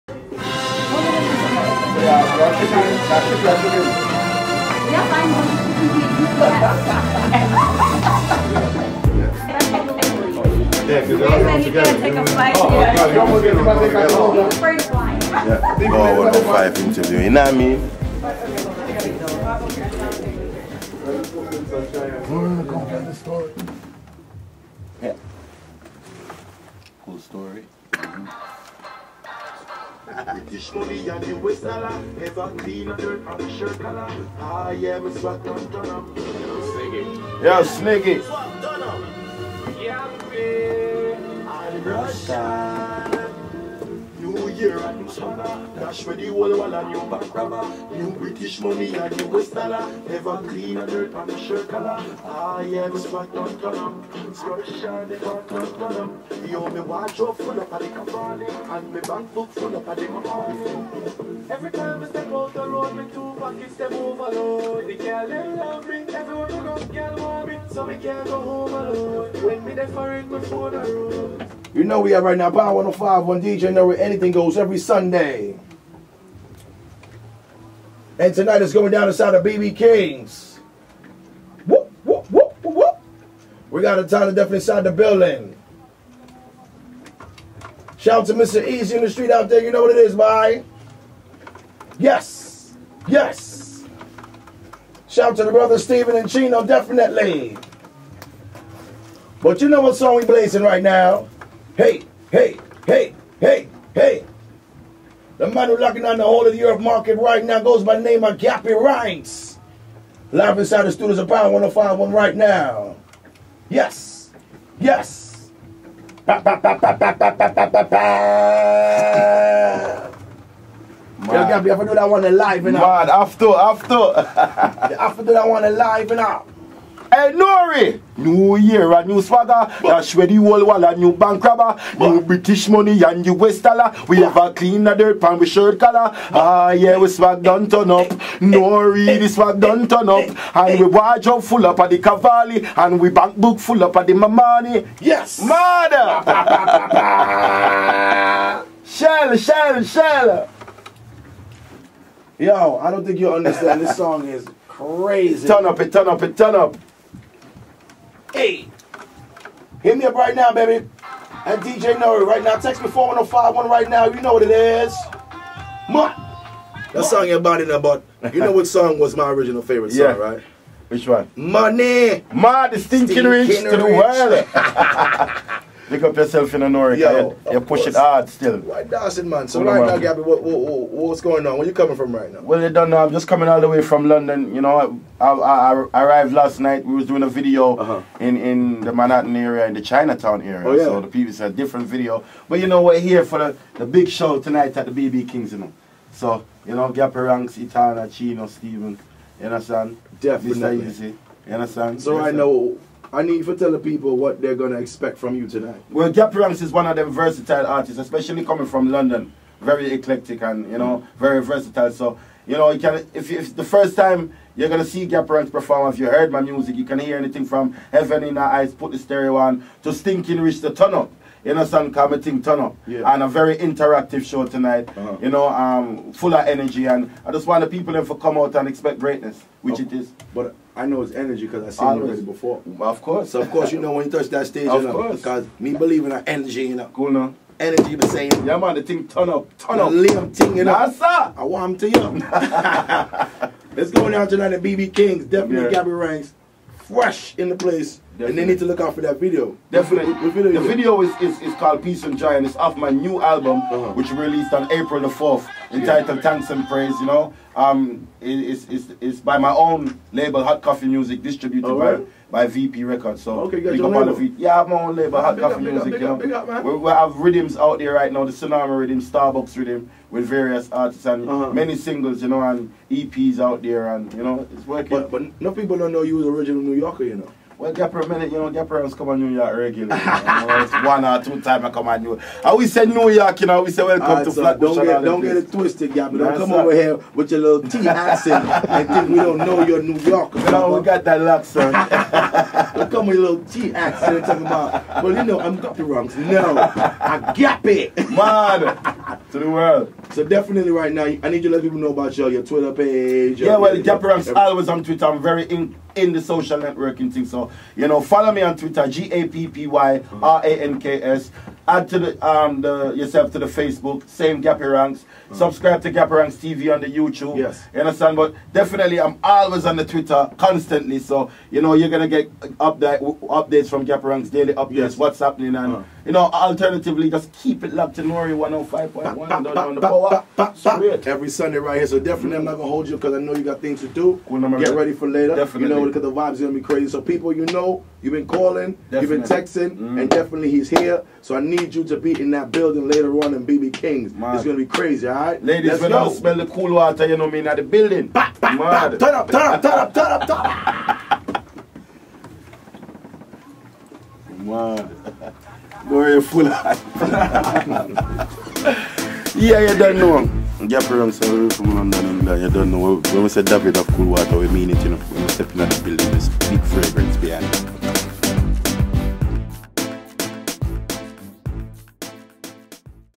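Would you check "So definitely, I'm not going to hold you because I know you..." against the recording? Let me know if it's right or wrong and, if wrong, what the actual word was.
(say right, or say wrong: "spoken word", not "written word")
right.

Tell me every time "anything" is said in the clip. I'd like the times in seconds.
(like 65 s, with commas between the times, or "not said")
73 s, 217 s.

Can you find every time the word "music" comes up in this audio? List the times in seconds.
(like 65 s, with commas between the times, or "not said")
216 s, 260 s, 265 s.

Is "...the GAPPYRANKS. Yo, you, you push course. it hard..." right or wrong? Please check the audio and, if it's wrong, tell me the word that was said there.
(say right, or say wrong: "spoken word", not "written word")
wrong: "Norica", not "GAPPYRANKS".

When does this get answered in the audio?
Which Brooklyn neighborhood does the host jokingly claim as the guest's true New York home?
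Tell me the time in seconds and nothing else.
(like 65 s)
284 s.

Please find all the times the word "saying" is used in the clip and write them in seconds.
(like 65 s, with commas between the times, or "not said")
238 s.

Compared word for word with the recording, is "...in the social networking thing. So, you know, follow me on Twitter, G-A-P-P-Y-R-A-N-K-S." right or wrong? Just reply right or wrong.
right.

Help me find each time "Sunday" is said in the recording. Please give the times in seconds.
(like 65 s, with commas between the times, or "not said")
74 s, 331 s.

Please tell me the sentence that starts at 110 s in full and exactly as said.
Live inside the studios of Power oh One right now.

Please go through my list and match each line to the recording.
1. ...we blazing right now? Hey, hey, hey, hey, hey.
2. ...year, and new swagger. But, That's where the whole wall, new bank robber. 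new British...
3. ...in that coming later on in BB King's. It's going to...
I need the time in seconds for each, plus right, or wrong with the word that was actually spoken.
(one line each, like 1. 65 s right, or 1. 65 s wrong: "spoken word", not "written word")
1. 100 s right
2. 128 s right
3. 342 s wrong: "building", not "coming".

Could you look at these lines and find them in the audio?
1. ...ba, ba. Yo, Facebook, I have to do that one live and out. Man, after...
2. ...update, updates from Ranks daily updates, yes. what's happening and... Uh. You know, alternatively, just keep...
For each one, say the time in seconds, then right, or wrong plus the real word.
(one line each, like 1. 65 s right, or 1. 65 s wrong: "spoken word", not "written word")
1. 117 s wrong: "Gappy", not "Facebook"
2. 322 s right.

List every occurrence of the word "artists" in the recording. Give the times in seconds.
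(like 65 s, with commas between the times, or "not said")
207 s, 270 s.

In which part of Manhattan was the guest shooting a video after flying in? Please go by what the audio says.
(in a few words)
Chinatown.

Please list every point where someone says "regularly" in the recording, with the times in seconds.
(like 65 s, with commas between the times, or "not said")
279 s.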